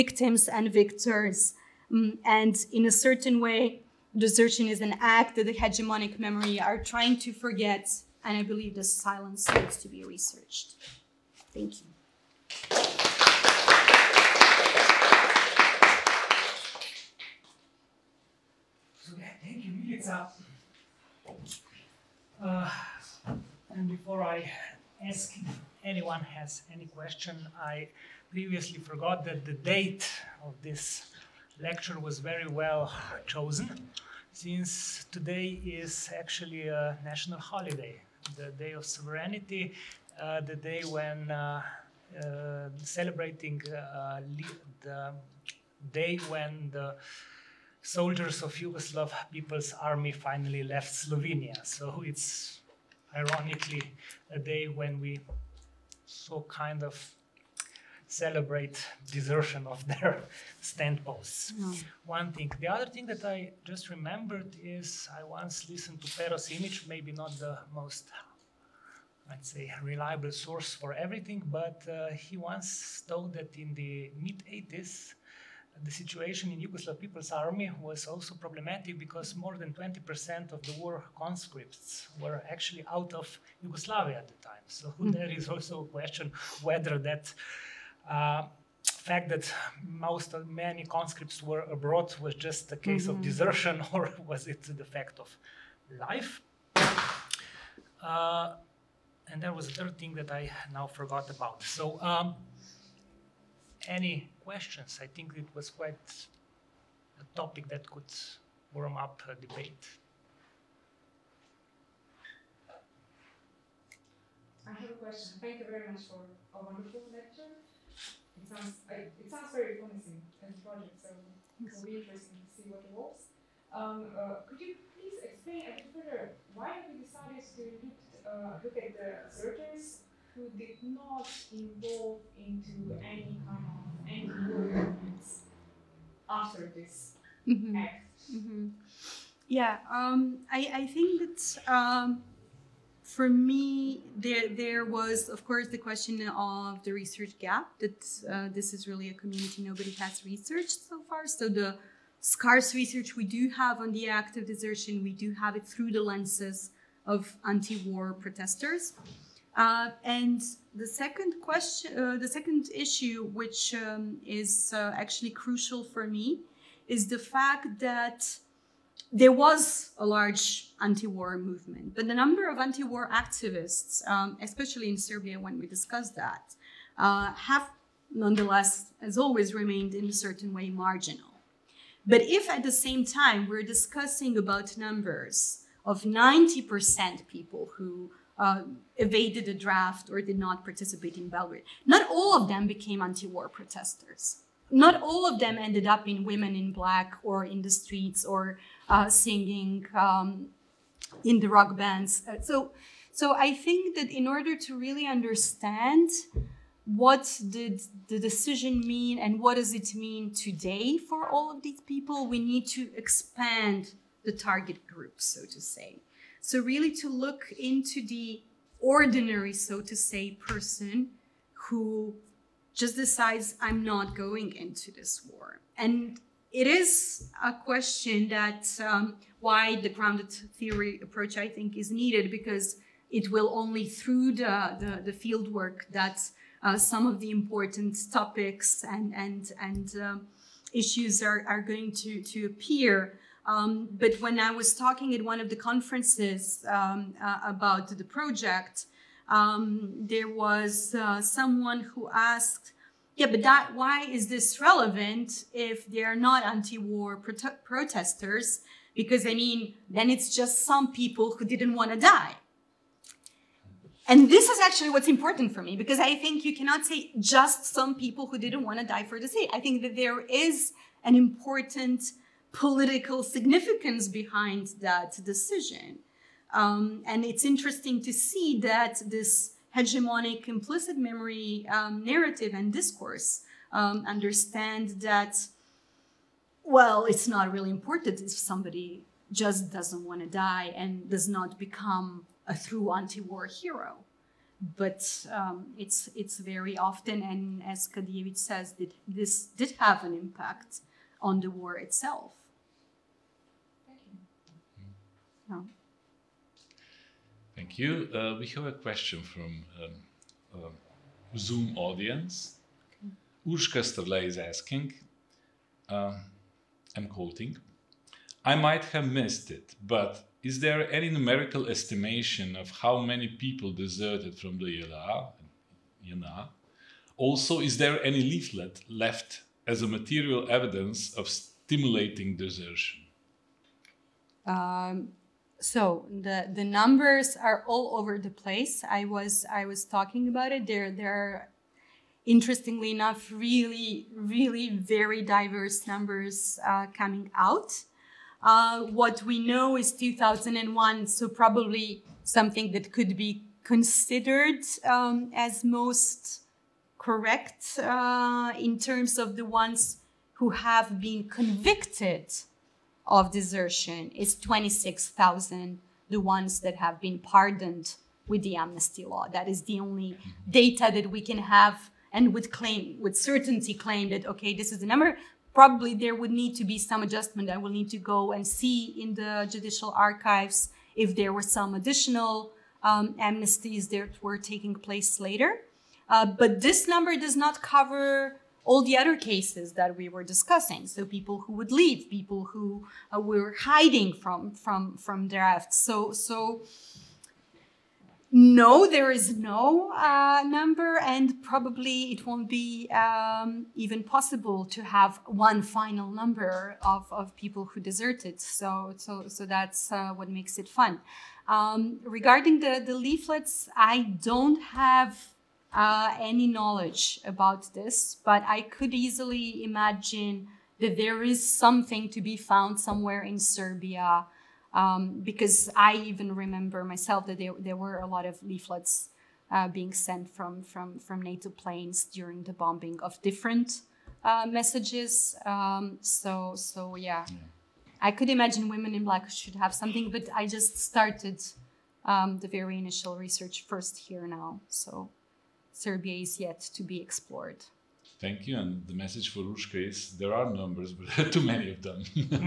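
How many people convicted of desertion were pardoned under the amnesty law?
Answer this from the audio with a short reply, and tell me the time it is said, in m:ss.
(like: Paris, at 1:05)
26,000, at 6:04.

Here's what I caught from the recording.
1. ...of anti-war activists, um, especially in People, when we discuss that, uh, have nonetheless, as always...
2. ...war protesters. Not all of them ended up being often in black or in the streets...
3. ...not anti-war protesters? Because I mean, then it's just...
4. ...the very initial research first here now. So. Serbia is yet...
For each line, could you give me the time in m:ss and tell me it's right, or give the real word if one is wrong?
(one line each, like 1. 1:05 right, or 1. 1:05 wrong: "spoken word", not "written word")
1. 2:52 wrong: "Serbia", not "People"
2. 3:13 wrong: "women", not "often"
3. 4:16 right
4. 7:22 right.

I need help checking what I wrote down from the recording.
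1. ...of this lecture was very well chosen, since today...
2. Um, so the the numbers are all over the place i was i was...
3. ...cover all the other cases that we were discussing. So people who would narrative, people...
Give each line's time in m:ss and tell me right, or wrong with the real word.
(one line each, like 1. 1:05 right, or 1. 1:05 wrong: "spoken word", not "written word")
1. 0:30 right
2. 5:34 right
3. 6:27 wrong: "leave", not "narrative".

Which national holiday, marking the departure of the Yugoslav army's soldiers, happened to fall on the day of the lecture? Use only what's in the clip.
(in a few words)
Day of Sovereignty.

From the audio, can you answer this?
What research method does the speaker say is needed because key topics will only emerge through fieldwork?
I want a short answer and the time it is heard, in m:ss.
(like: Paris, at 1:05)
Grounded theory, at 3:49.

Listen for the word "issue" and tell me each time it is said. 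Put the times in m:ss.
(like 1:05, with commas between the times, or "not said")
2:42, 4:00.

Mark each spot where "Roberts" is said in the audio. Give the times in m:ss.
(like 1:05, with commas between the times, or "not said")
not said.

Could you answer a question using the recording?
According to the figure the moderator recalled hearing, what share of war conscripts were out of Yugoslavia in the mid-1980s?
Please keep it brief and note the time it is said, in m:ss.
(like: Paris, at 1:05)
More than 20%, at 1:19.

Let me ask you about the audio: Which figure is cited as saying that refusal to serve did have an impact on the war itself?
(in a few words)
Kadijević.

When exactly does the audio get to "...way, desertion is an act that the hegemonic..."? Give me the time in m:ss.
0:03.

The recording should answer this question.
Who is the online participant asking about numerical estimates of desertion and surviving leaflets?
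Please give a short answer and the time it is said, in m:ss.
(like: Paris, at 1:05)
Urška Sterle, at 5:13.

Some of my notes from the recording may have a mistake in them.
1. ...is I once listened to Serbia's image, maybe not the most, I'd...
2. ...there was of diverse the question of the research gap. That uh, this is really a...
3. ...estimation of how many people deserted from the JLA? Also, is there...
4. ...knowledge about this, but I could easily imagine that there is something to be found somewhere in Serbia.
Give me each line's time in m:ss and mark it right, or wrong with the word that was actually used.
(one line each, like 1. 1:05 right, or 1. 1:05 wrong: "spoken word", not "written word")
1. 1:04 wrong: "Pero", not "Serbia"
2. 2:24 wrong: "course", not "diverse"
3. 5:21 right
4. 6:56 right.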